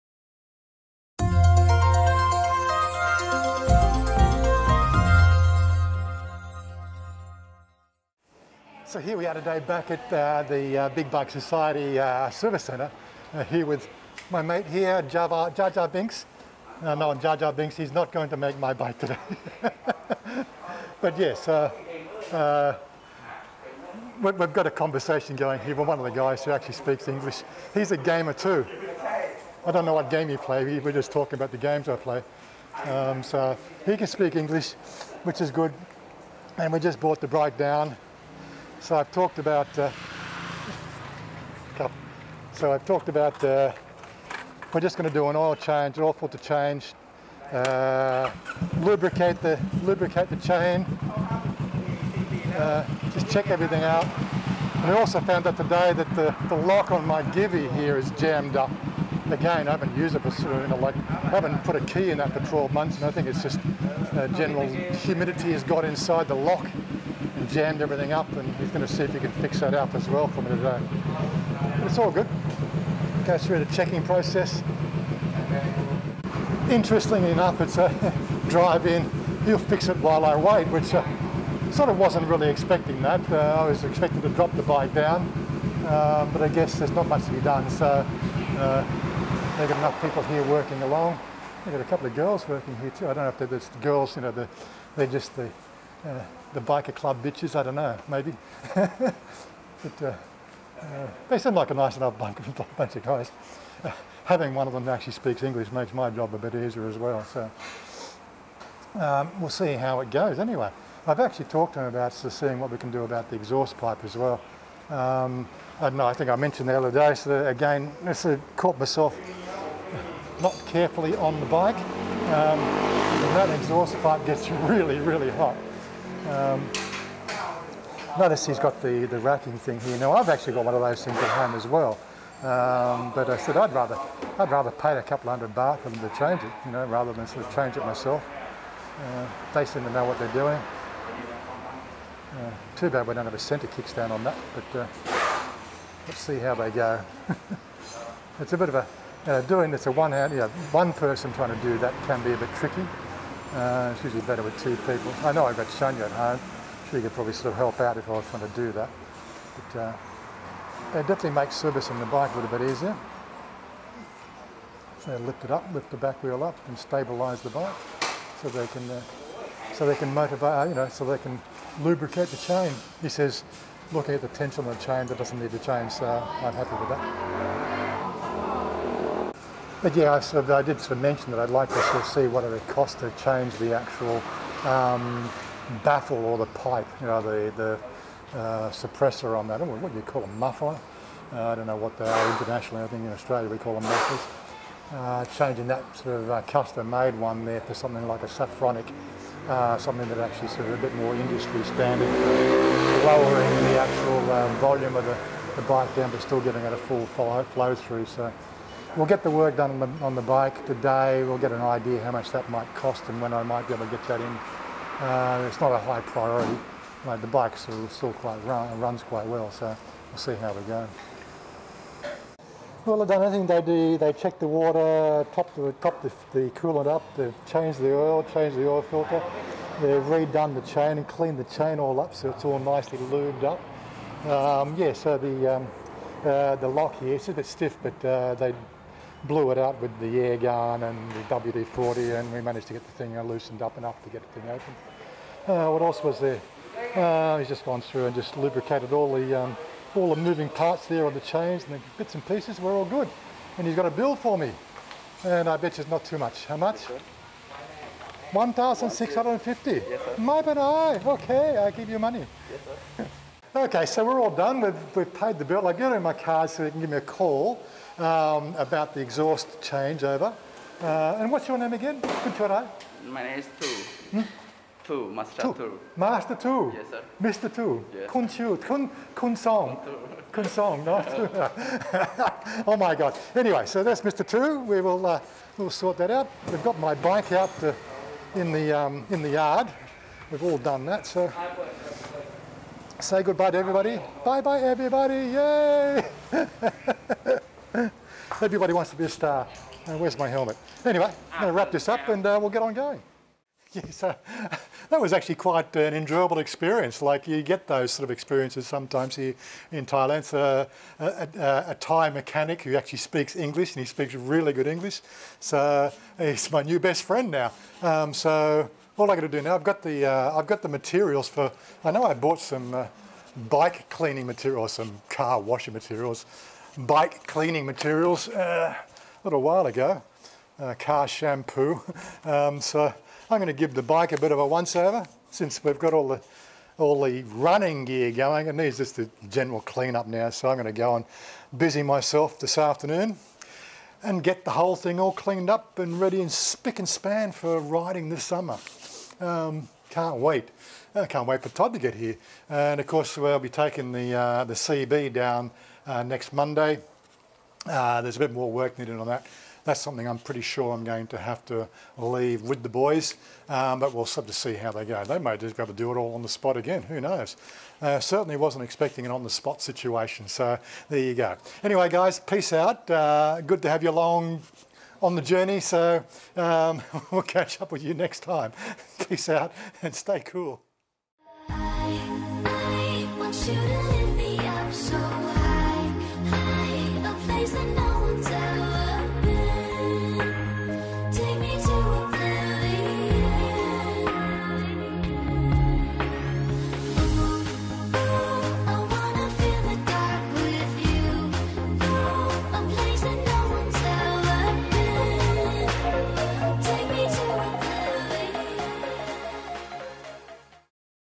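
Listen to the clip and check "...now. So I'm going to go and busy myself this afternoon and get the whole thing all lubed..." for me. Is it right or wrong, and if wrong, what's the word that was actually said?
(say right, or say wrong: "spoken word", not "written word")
wrong: "cleaned", not "lubed".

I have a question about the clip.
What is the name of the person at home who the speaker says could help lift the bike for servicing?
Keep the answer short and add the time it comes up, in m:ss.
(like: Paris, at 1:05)
Chanya, at 2:35.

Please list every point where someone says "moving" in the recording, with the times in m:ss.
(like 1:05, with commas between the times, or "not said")
4:10.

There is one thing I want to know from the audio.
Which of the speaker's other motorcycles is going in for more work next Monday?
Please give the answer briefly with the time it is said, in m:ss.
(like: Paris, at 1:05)
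the CB, at 5:54.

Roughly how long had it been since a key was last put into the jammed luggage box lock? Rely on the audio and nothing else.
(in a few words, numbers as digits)
12 months.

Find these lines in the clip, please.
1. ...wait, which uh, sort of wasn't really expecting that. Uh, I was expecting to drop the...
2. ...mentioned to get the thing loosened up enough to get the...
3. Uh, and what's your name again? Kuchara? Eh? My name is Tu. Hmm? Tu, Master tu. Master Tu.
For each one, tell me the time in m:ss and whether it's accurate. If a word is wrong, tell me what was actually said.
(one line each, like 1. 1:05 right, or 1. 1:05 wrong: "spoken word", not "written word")
1. 1:20 right
2. 4:02 wrong: "managed", not "mentioned"
3. 4:30 right.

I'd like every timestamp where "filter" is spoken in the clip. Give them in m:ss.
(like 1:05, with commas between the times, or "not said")
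0:46, 3:48.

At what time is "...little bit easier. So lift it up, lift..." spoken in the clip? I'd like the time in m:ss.
2:42.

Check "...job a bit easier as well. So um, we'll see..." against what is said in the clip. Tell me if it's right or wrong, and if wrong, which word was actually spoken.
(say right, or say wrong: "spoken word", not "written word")
right.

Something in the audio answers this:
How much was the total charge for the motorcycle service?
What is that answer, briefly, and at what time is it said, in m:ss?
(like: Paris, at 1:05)
1,650, at 4:18.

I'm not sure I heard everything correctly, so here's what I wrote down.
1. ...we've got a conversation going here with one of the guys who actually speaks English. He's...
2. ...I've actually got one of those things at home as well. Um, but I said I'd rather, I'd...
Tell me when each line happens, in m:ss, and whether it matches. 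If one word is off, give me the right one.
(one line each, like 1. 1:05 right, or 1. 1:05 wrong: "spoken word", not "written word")
1. 0:24 right
2. 2:10 right.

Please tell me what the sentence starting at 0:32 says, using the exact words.
Um, so he can speak English, which is good.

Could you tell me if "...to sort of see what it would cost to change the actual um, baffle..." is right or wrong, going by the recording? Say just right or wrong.
right.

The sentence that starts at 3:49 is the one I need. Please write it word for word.
They've redone the chain and cleaned the chain all up, so it's all nicely lubed up.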